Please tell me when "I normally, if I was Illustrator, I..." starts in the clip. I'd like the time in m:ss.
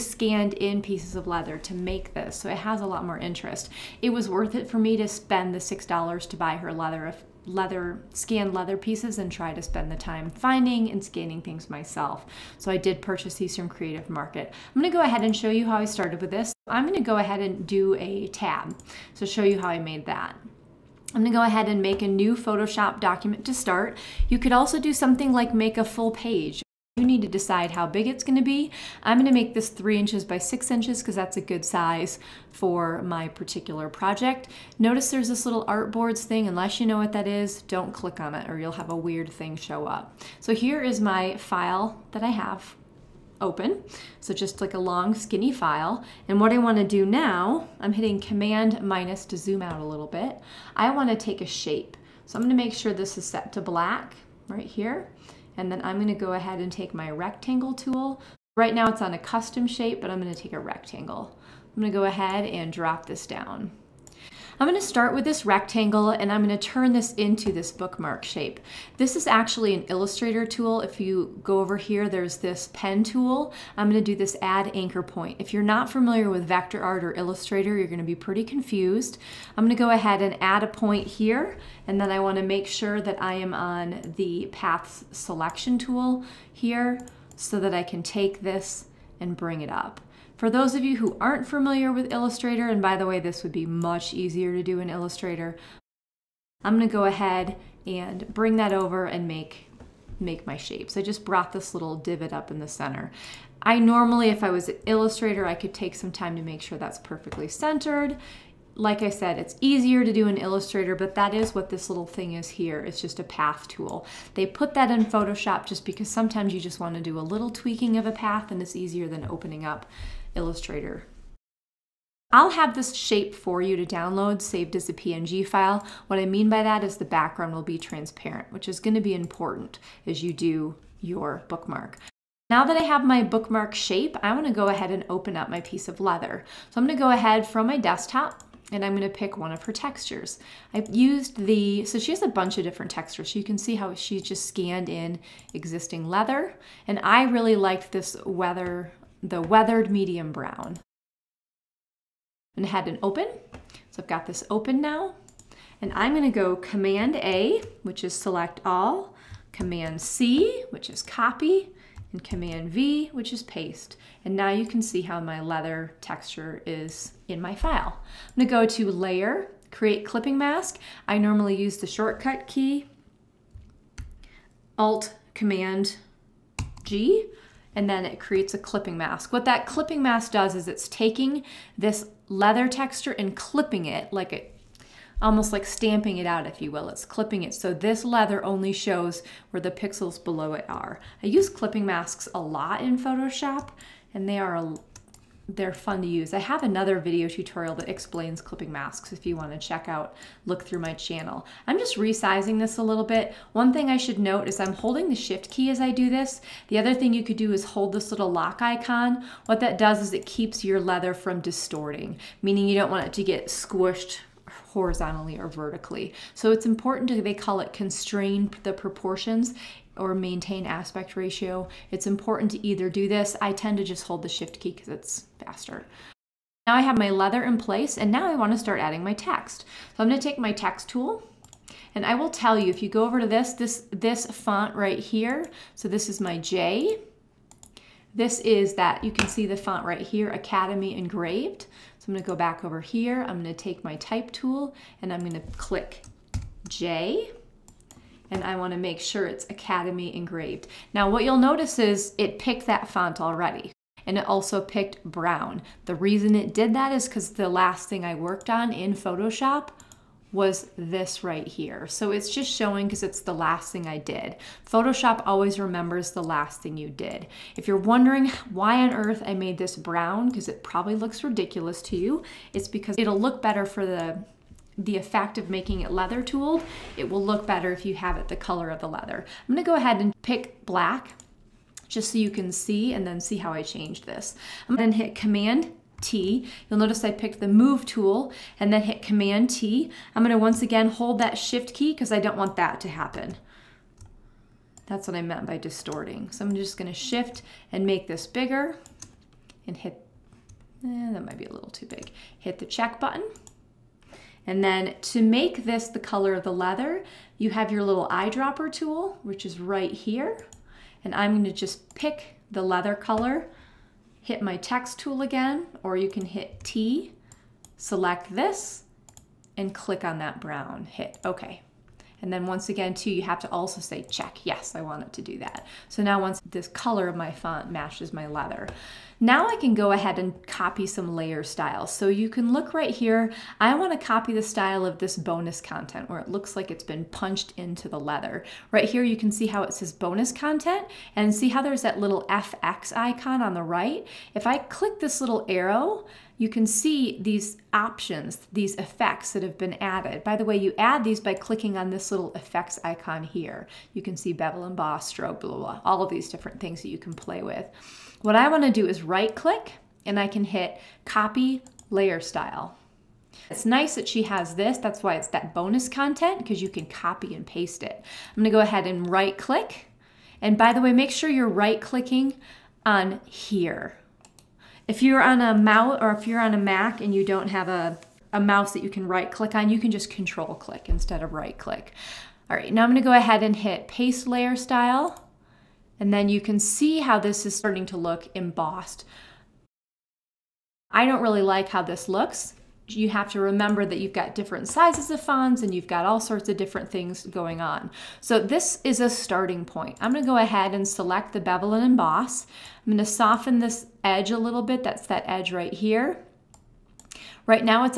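1:43.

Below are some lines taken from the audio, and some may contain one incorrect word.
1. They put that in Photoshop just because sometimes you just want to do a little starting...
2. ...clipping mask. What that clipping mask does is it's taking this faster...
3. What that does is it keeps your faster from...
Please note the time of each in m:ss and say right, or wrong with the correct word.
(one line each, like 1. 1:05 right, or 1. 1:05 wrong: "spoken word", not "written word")
1. 1:54 wrong: "tweaking", not "starting"
2. 2:58 wrong: "leather", not "faster"
3. 3:29 wrong: "leather", not "faster".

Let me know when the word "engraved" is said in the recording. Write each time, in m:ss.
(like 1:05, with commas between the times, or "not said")
4:00, 4:10.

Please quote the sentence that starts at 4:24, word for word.
Photoshop always remembers the last thing you did.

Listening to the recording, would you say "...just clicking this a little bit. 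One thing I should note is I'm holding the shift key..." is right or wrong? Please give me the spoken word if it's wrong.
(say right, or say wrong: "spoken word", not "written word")
wrong: "resizing", not "clicking".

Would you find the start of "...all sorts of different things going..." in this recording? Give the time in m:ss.
6:36.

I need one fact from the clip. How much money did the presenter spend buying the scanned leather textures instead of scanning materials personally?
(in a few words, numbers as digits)
$6.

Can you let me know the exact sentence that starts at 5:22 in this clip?
And then once again, too, you have to also say, check, yes, I want it to do that.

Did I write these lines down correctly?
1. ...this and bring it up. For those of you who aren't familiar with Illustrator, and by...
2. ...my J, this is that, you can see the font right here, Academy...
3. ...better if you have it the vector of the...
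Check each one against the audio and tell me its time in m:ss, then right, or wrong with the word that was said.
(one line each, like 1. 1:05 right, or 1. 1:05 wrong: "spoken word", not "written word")
1. 1:28 right
2. 3:56 right
3. 4:37 wrong: "color", not "vector".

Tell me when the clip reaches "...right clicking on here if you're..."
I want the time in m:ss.
6:11.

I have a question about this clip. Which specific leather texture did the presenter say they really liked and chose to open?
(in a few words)
weathered medium brown.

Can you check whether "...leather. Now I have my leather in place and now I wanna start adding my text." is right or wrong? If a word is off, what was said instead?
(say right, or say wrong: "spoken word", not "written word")
wrong: "faster", not "leather".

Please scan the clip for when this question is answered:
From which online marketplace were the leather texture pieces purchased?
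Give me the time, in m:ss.
0:13.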